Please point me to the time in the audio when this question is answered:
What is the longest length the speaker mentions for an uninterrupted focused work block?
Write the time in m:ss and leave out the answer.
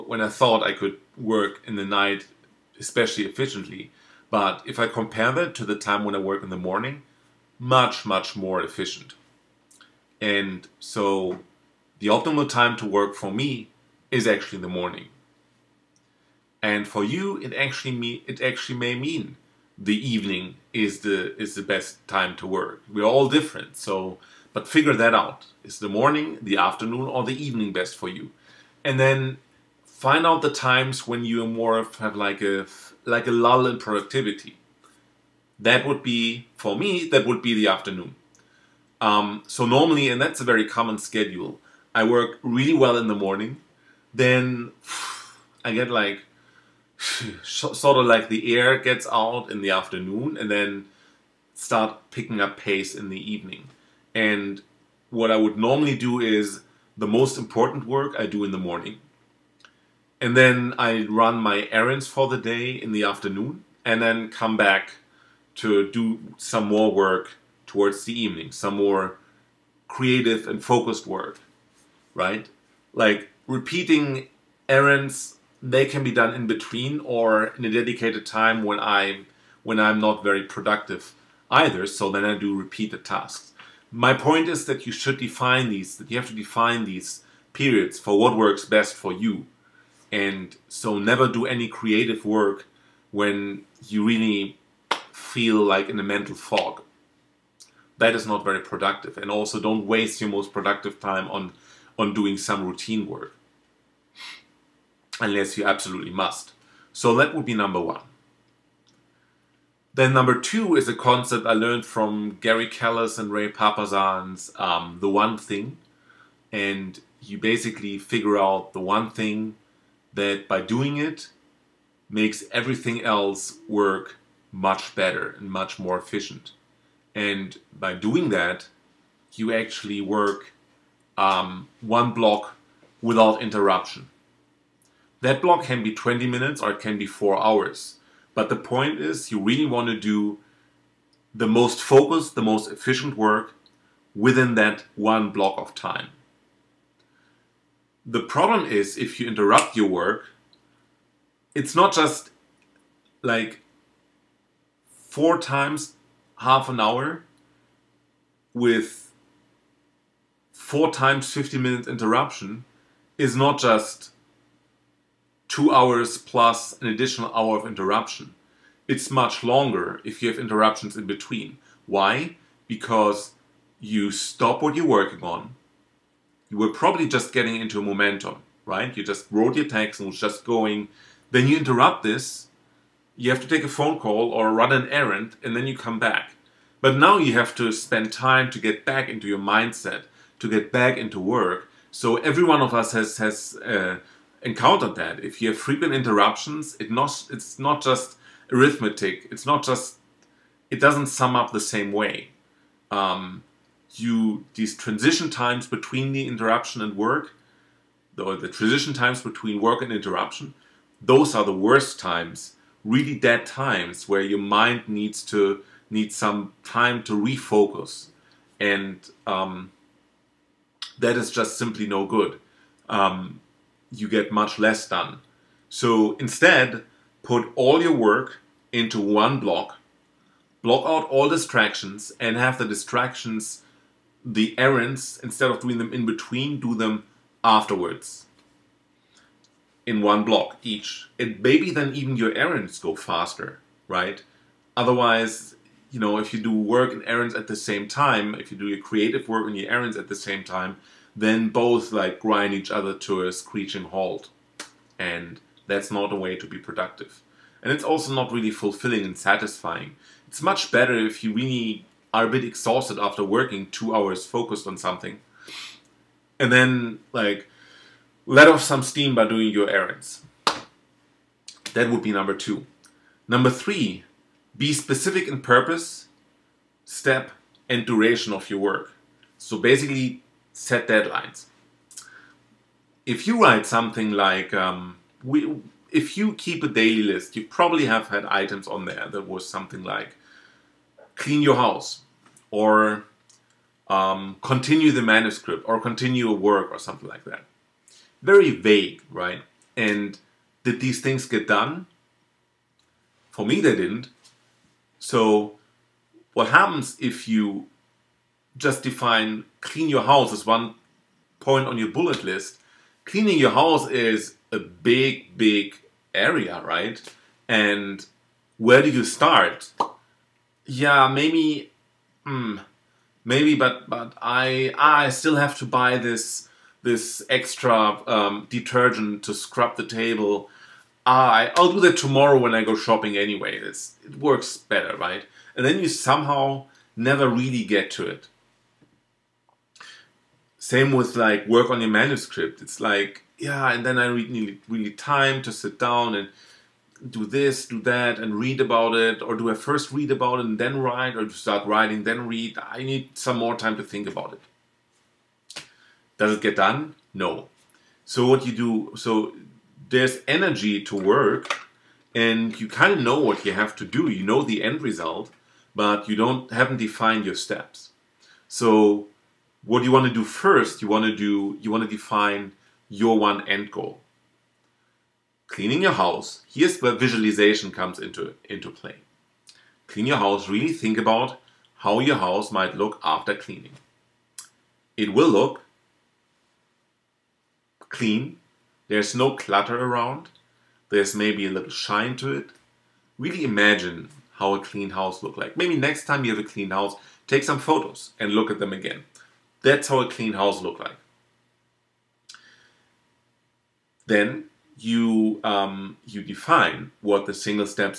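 2:17.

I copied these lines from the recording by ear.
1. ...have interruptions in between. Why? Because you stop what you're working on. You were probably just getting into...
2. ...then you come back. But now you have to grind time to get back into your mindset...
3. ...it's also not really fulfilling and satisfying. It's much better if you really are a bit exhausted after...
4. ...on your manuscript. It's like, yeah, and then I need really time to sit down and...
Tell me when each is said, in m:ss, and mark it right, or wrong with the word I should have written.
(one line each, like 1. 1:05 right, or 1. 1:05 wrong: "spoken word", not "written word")
1. 2:50 right
2. 3:05 wrong: "spend", not "grind"
3. 4:17 right
4. 5:41 right.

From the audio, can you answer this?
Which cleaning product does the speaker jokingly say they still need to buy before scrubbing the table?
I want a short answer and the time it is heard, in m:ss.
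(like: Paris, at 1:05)
detergent, at 5:28.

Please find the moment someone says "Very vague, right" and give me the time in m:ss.
4:58.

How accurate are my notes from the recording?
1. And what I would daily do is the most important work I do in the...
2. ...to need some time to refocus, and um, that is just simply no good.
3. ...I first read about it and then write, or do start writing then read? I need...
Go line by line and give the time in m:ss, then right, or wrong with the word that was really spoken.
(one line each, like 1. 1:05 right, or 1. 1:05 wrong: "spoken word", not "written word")
1. 0:54 wrong: "normally", not "daily"
2. 3:35 right
3. 5:49 right.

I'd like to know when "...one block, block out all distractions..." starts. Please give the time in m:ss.
3:48.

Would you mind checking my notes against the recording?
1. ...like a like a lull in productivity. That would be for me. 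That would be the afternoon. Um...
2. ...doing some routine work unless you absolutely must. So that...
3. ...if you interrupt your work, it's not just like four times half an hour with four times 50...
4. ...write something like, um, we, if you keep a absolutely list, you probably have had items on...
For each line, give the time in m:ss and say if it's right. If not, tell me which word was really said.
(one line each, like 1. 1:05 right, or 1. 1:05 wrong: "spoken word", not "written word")
1. 0:32 right
2. 1:42 right
3. 2:28 right
4. 4:43 wrong: "daily", not "absolutely".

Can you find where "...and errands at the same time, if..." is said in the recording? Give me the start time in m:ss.
4:06.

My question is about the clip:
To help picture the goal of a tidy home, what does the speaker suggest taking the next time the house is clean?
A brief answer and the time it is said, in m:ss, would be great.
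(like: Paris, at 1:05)
photos, at 6:37.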